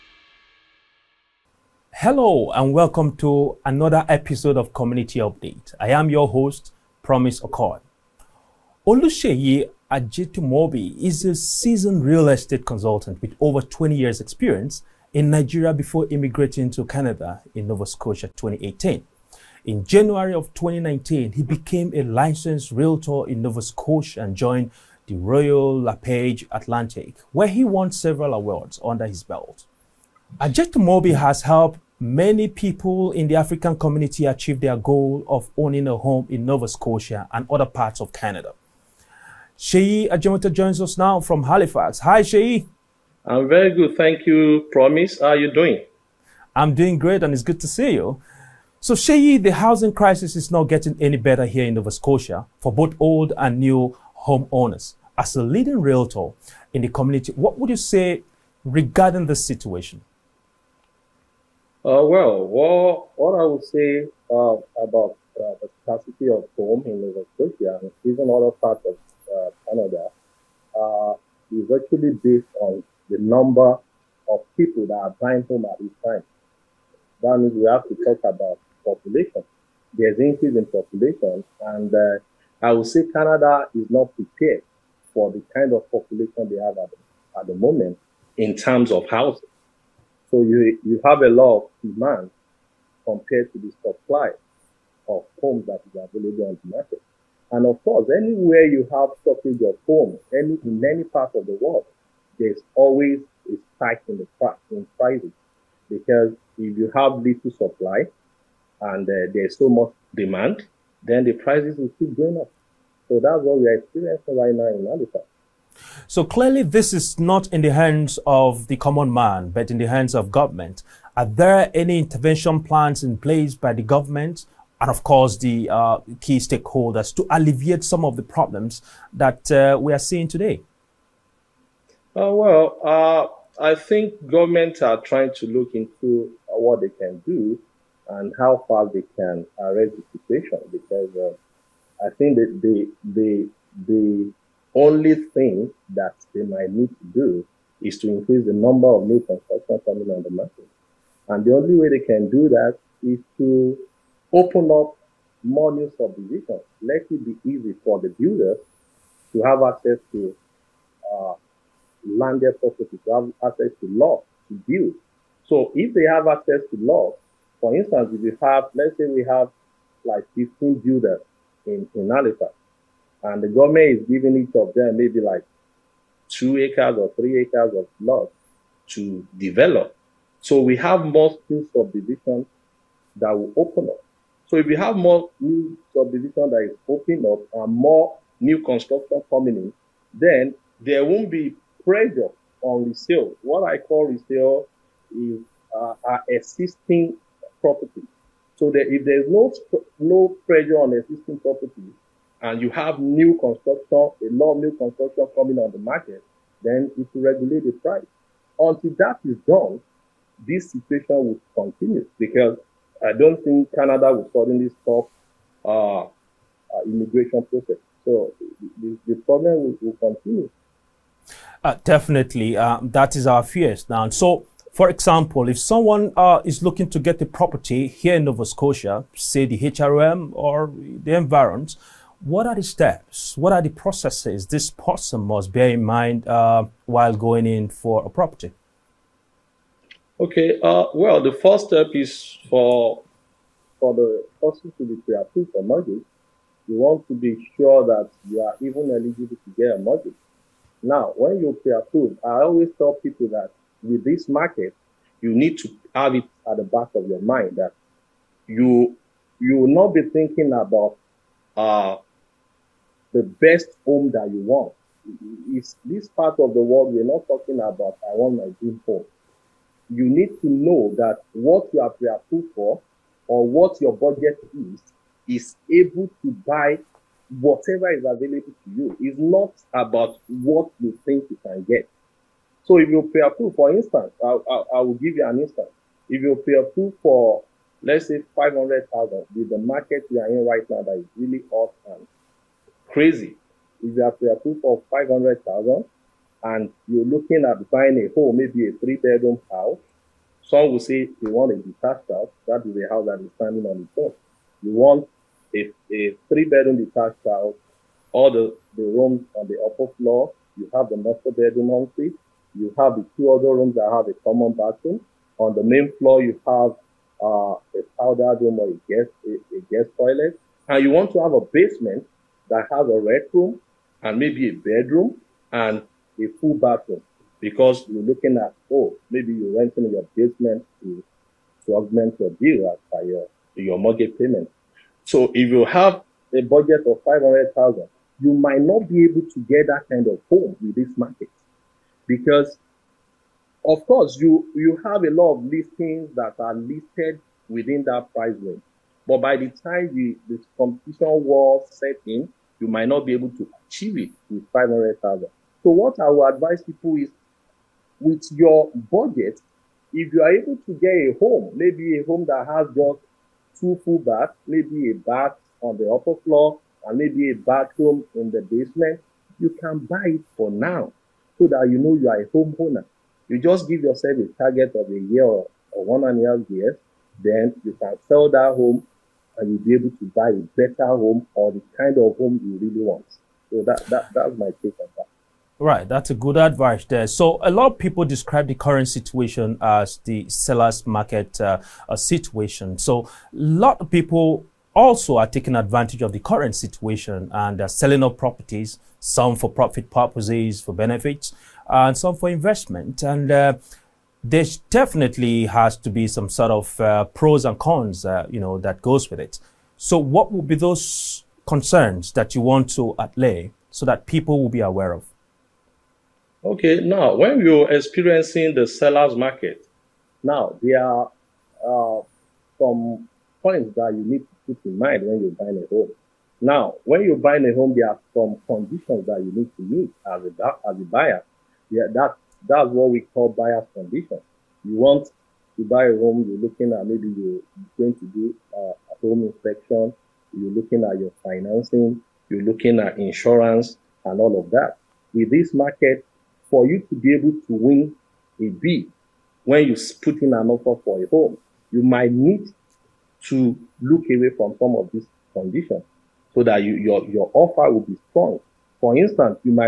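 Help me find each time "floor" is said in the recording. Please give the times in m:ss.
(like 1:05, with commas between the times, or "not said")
5:09, 5:15, 6:06.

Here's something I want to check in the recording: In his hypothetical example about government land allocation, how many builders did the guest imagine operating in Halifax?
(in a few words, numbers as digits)
15.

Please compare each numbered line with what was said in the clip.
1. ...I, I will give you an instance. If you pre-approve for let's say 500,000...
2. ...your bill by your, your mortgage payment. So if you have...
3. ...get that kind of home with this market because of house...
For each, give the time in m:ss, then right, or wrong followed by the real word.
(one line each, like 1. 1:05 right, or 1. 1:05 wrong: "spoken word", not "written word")
1. 4:44 right
2. 5:32 right
3. 5:39 wrong: "course", not "house".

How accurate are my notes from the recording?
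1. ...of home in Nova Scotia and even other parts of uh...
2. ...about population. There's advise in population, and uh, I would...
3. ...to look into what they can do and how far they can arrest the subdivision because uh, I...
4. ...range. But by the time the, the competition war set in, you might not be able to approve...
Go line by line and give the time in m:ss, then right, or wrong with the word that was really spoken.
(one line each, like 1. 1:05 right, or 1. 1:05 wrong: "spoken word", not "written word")
1. 1:06 right
2. 1:18 wrong: "increase", not "advise"
3. 2:15 wrong: "situation", not "subdivision"
4. 5:48 wrong: "achieve", not "approve".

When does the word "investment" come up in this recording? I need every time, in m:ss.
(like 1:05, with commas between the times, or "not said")
6:42.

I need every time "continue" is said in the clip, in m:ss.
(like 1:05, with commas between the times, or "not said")
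3:31, 3:40.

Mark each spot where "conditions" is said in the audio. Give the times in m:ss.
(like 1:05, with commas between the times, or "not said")
7:08, 7:13, 7:35.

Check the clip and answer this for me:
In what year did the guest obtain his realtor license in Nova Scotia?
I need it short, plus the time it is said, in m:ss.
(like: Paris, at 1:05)
2019, at 0:20.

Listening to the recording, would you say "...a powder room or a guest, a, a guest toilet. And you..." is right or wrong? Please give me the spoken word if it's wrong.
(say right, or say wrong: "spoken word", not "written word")
right.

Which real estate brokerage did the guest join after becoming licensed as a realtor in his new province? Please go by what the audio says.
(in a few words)
Royal LePage Atlantic.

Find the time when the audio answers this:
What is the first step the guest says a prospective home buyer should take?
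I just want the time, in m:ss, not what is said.
4:05.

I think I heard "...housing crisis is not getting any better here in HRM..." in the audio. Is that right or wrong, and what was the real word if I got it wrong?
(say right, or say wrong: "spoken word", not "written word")
wrong: "Nova", not "HRM".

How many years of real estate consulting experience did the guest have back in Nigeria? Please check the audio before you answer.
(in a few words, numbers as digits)
20 years.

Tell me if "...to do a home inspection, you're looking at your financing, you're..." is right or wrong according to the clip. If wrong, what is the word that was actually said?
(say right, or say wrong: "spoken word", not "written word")
right.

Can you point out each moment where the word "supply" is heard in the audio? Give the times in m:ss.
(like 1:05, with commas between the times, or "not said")
1:33, 1:47.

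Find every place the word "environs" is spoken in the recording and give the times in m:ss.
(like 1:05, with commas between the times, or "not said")
3:51.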